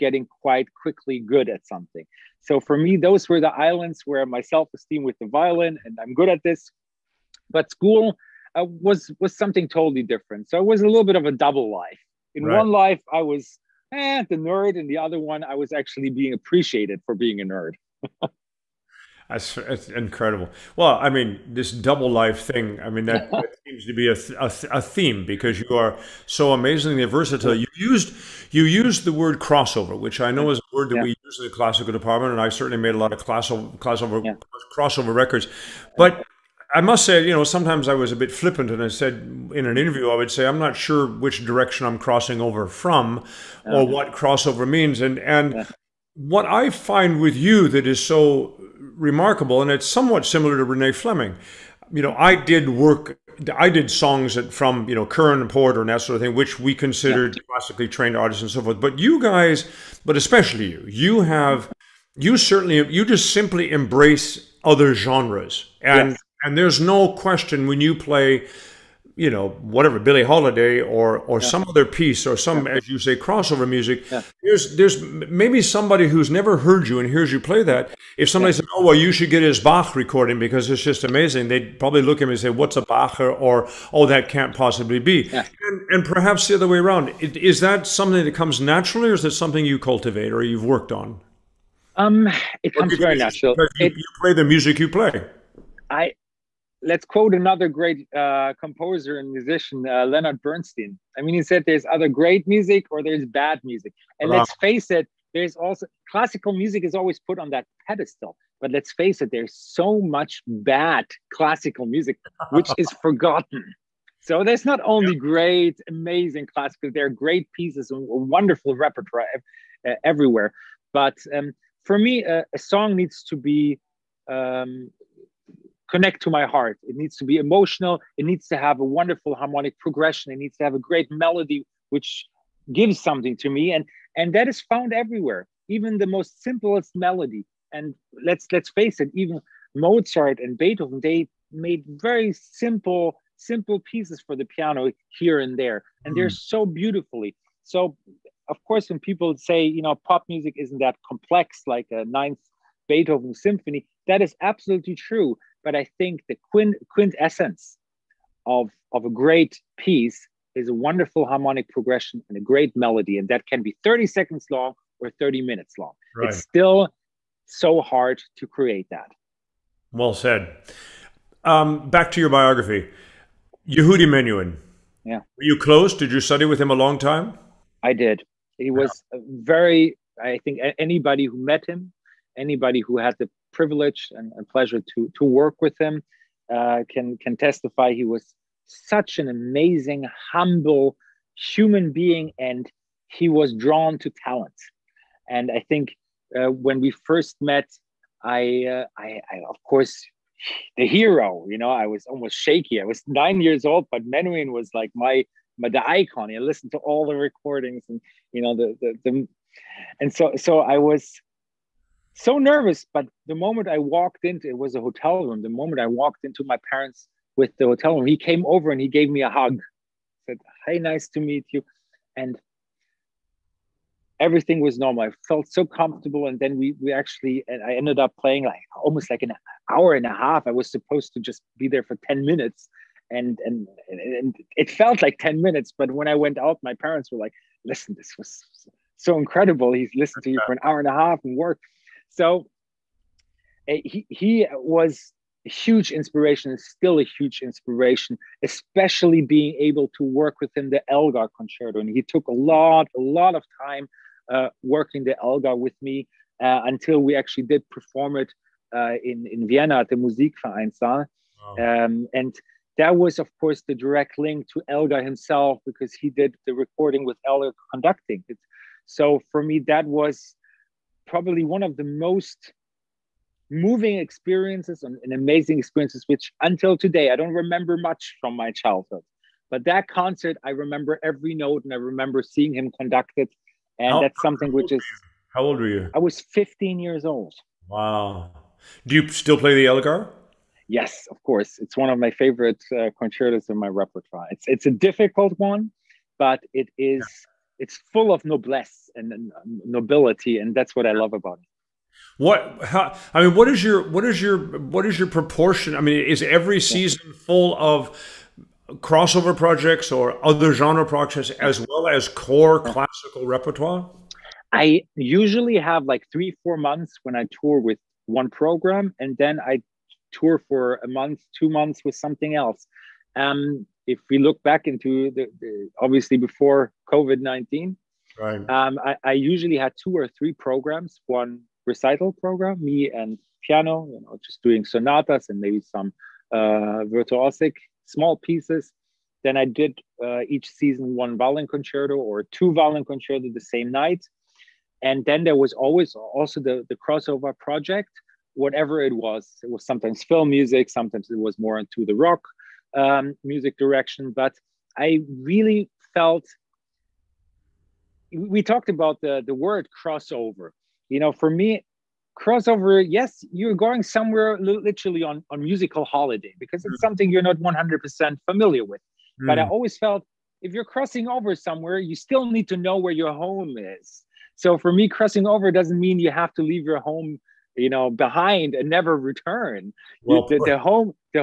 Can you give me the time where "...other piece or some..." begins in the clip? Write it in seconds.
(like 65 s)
71 s.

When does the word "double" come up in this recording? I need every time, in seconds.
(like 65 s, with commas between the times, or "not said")
11 s, 21 s.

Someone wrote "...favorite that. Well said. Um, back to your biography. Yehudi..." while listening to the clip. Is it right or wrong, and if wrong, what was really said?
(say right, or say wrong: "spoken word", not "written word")
wrong: "create", not "favorite".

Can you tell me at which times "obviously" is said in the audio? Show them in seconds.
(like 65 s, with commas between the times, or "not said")
325 s.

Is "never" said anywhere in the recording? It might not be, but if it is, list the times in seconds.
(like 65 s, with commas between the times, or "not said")
76 s, 378 s.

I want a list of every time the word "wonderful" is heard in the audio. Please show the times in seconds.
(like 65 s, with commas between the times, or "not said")
118 s, 128 s, 160 s.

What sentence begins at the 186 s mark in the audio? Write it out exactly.
Uh, can can testify he was such an amazing, humble human being, and he was drawn to talent.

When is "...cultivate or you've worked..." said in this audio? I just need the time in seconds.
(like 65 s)
89 s.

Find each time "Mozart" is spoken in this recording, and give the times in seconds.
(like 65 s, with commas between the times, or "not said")
139 s.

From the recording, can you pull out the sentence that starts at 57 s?
classically trained artists and so forth.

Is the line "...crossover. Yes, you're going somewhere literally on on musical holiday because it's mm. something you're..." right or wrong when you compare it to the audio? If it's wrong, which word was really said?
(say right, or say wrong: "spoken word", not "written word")
right.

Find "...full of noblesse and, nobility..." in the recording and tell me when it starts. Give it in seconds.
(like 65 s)
297 s.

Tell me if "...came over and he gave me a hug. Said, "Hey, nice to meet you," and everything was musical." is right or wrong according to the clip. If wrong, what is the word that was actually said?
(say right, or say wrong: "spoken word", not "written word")
wrong: "normal", not "musical".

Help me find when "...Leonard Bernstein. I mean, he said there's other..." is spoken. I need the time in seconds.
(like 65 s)
100 s.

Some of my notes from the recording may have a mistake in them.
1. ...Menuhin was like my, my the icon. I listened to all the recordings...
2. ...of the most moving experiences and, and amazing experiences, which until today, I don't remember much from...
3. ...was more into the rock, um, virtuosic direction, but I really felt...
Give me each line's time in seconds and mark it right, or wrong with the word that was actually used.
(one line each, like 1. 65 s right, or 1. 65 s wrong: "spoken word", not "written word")
1. 204 s right
2. 271 s right
3. 351 s wrong: "music", not "virtuosic".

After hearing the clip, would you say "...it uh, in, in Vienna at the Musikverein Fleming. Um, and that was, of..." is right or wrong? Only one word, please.
wrong.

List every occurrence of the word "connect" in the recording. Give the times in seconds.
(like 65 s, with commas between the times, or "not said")
125 s.